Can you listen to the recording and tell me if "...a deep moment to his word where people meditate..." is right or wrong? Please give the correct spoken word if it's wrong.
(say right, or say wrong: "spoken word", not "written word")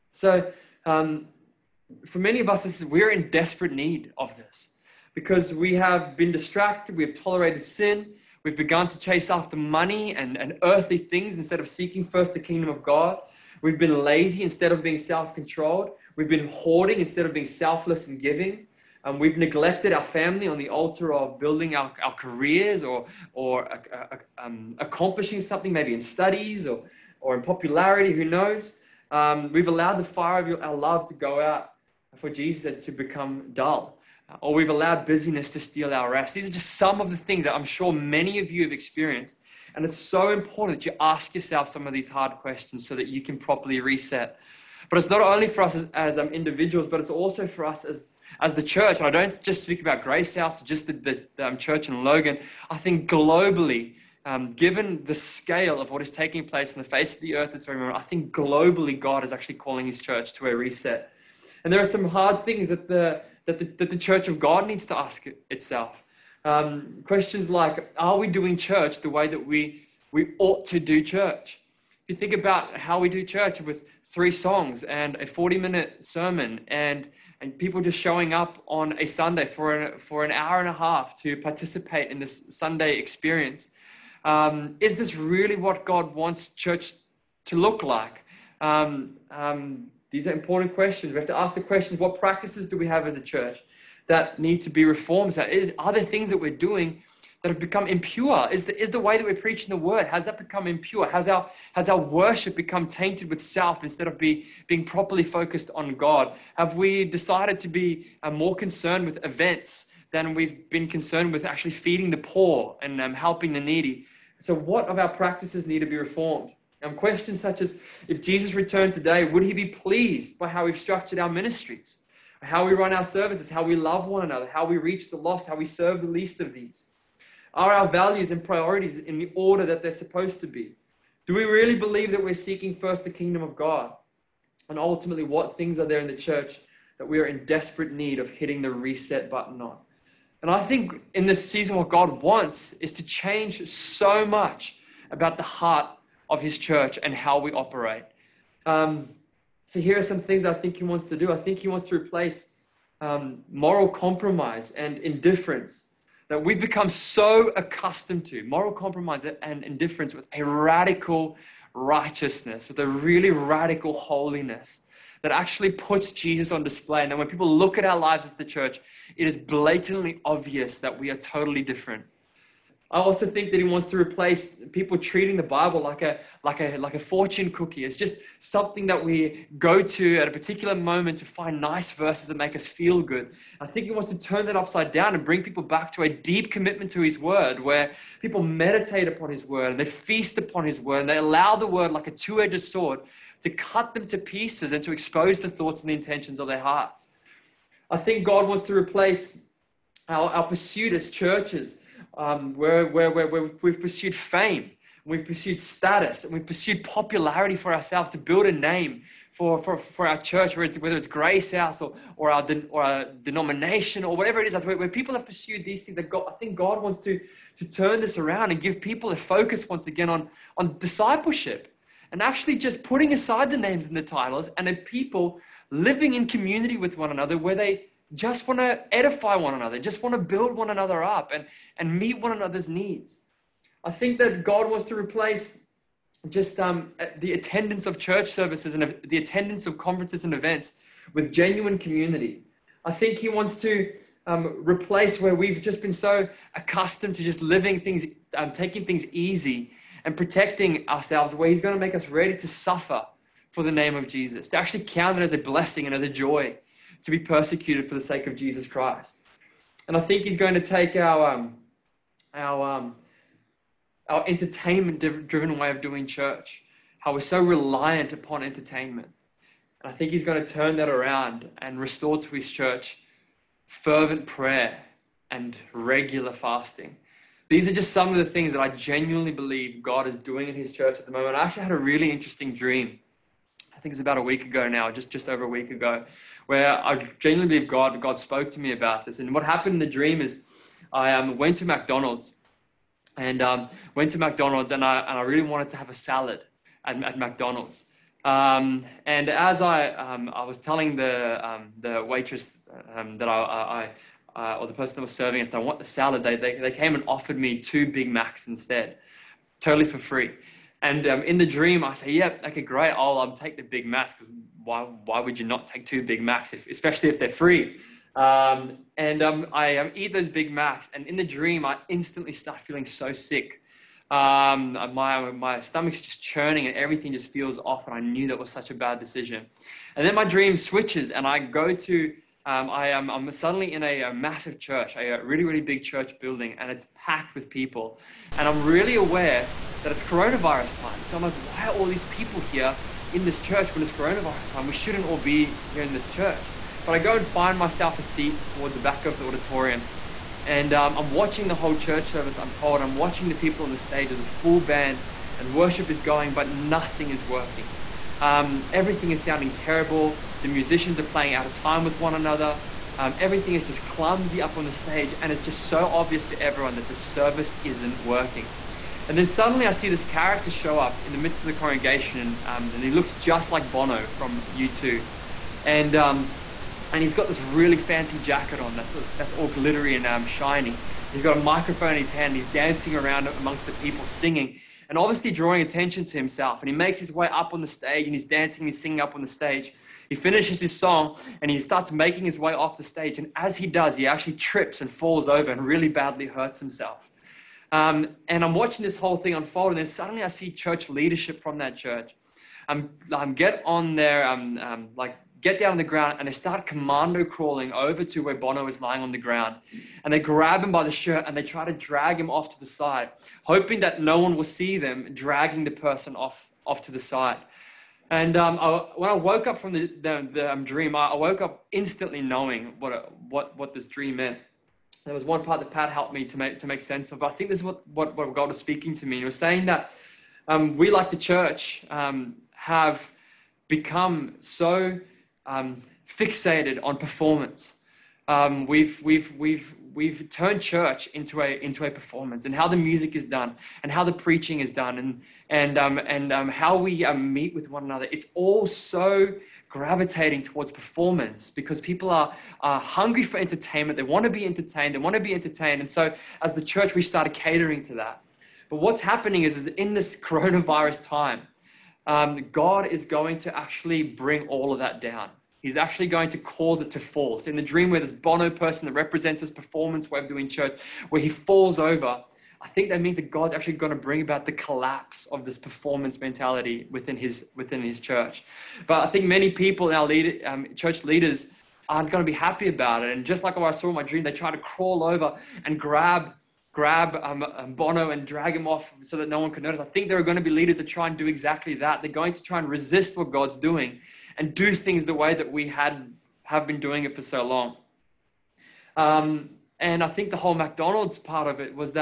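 wrong: "commitment", not "moment".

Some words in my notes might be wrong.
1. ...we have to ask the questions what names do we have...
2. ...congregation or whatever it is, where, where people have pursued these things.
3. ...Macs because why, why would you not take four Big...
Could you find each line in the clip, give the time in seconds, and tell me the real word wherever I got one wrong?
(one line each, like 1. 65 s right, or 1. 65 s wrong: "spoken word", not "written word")
1. 91 s wrong: "practices", not "names"
2. 213 s wrong: "denomination", not "congregation"
3. 313 s wrong: "two", not "four".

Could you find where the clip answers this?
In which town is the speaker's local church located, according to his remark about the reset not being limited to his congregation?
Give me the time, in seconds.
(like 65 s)
52 s.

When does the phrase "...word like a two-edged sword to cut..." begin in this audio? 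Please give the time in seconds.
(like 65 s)
191 s.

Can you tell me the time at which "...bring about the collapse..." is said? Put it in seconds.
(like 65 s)
473 s.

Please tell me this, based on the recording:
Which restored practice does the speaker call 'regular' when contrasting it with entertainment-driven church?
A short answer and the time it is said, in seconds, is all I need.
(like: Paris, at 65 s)
fasting, at 275 s.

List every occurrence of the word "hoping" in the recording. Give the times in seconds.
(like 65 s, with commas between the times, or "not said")
413 s.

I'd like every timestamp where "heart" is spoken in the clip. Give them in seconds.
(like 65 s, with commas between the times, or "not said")
145 s, 196 s.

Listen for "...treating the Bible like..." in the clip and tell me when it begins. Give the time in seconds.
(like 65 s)
174 s.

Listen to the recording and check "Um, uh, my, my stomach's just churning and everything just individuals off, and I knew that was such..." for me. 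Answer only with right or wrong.
wrong.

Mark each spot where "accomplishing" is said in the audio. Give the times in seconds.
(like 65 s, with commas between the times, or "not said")
24 s.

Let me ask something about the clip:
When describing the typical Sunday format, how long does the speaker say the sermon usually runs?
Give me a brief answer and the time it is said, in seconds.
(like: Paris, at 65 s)
40 minutes, at 75 s.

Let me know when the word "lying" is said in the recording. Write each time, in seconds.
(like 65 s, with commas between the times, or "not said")
408 s.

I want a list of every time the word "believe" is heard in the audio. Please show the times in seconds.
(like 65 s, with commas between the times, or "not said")
131 s, 279 s, 287 s.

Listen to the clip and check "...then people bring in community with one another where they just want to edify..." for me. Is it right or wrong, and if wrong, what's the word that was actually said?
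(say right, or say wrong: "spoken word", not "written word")
wrong: "living", not "bring".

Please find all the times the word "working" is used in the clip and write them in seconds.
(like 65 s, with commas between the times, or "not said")
357 s, 368 s.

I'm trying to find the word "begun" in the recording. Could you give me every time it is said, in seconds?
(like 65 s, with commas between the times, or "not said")
8 s.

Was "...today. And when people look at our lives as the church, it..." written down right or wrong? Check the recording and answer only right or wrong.
wrong.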